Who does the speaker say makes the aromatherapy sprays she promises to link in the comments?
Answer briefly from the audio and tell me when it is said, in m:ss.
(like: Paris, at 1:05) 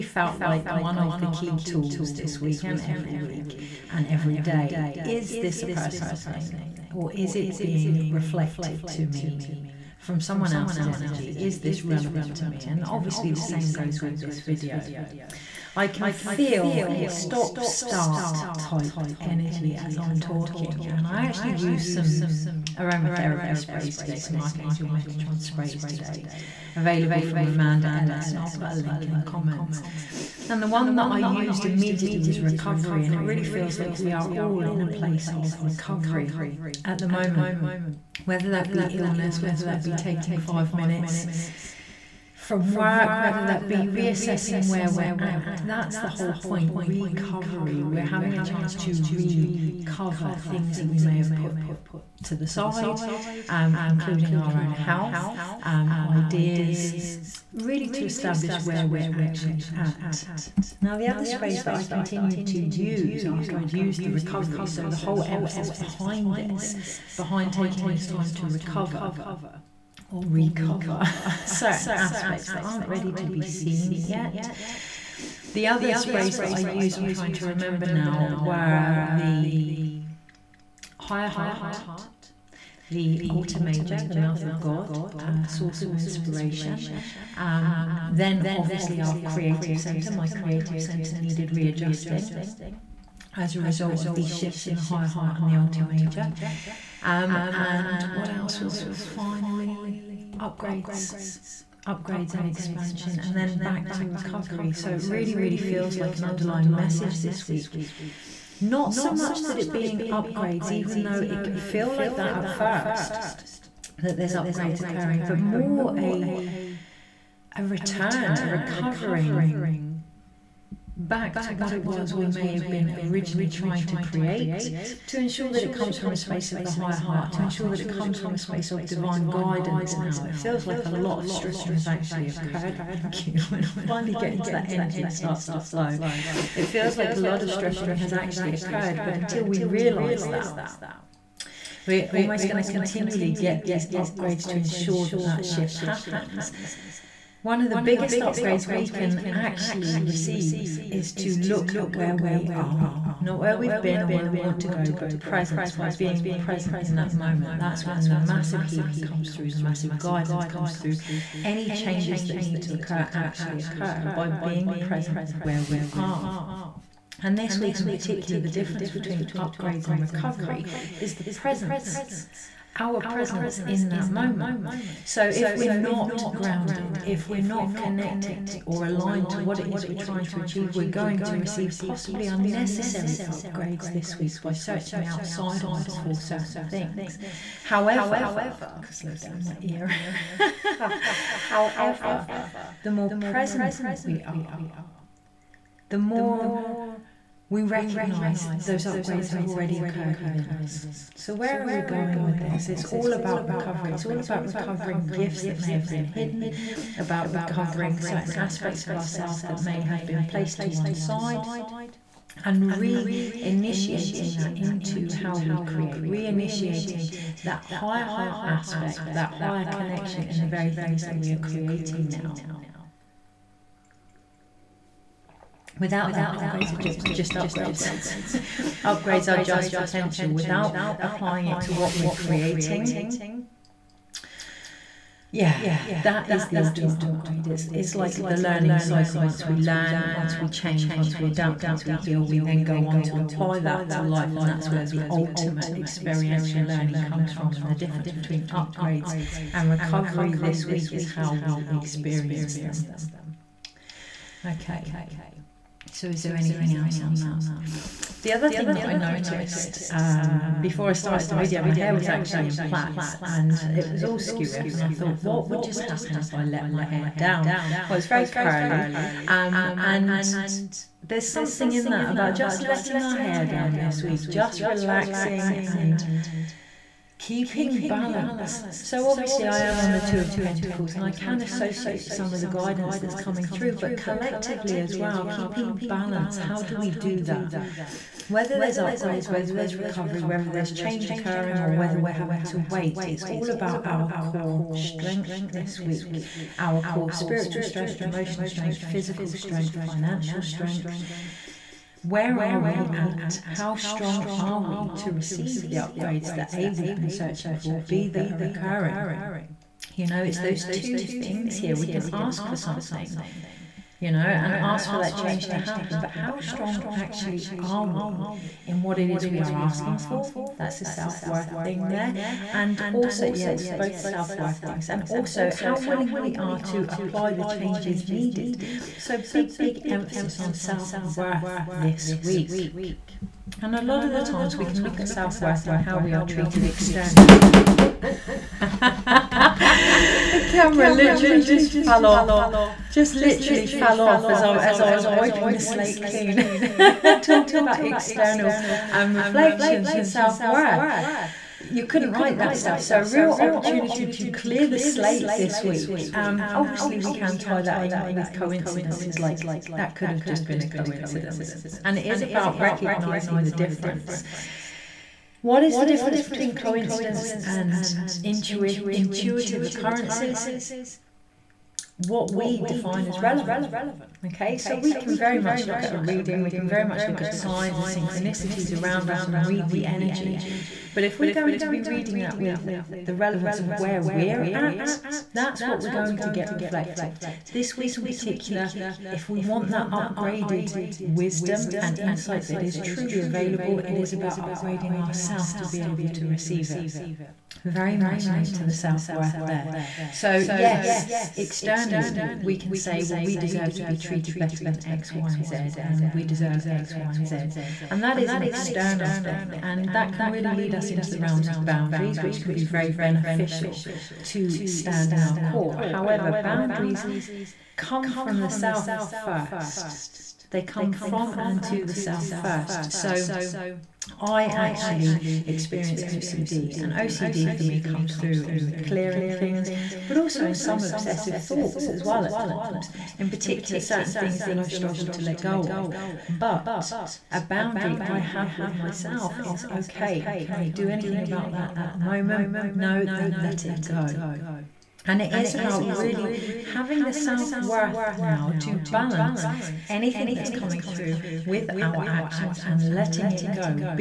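Amanda Ellis, at 0:27.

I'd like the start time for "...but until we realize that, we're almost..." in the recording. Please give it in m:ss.
2:19.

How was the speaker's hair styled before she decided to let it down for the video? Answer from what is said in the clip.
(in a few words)
Plaits.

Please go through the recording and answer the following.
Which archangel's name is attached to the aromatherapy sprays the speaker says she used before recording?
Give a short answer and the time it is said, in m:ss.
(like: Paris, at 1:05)
Metatron, at 0:24.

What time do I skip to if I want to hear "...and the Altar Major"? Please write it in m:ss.
1:35.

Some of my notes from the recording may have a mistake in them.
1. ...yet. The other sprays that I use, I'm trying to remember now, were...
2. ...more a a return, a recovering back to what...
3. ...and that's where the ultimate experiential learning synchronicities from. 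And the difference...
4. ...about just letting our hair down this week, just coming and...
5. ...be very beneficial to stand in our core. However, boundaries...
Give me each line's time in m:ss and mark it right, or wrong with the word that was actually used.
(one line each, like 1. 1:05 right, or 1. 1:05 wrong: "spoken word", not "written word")
1. 1:14 right
2. 1:55 right
3. 4:04 wrong: "comes", not "synchronicities"
4. 4:32 wrong: "relaxing", not "coming"
5. 6:52 right.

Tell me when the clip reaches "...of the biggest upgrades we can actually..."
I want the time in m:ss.
2:27.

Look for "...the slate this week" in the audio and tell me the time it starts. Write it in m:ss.
5:54.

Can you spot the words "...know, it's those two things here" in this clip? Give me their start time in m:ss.
5:10.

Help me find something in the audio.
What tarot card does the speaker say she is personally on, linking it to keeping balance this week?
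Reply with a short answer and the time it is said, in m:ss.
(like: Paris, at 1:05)
Two of Pentacles, at 4:40.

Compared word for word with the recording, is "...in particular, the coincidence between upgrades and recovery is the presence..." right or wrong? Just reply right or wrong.
wrong.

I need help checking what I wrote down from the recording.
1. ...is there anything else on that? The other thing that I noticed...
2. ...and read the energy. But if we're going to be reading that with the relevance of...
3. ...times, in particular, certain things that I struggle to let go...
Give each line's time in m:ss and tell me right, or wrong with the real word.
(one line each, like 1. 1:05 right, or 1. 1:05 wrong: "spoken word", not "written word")
1. 4:16 right
2. 6:19 right
3. 7:12 right.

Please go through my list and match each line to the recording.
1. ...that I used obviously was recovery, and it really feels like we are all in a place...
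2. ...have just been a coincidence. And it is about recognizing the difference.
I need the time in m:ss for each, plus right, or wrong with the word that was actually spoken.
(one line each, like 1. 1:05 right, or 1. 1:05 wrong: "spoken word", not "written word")
1. 0:30 wrong: "immediately", not "obviously"
2. 6:00 right.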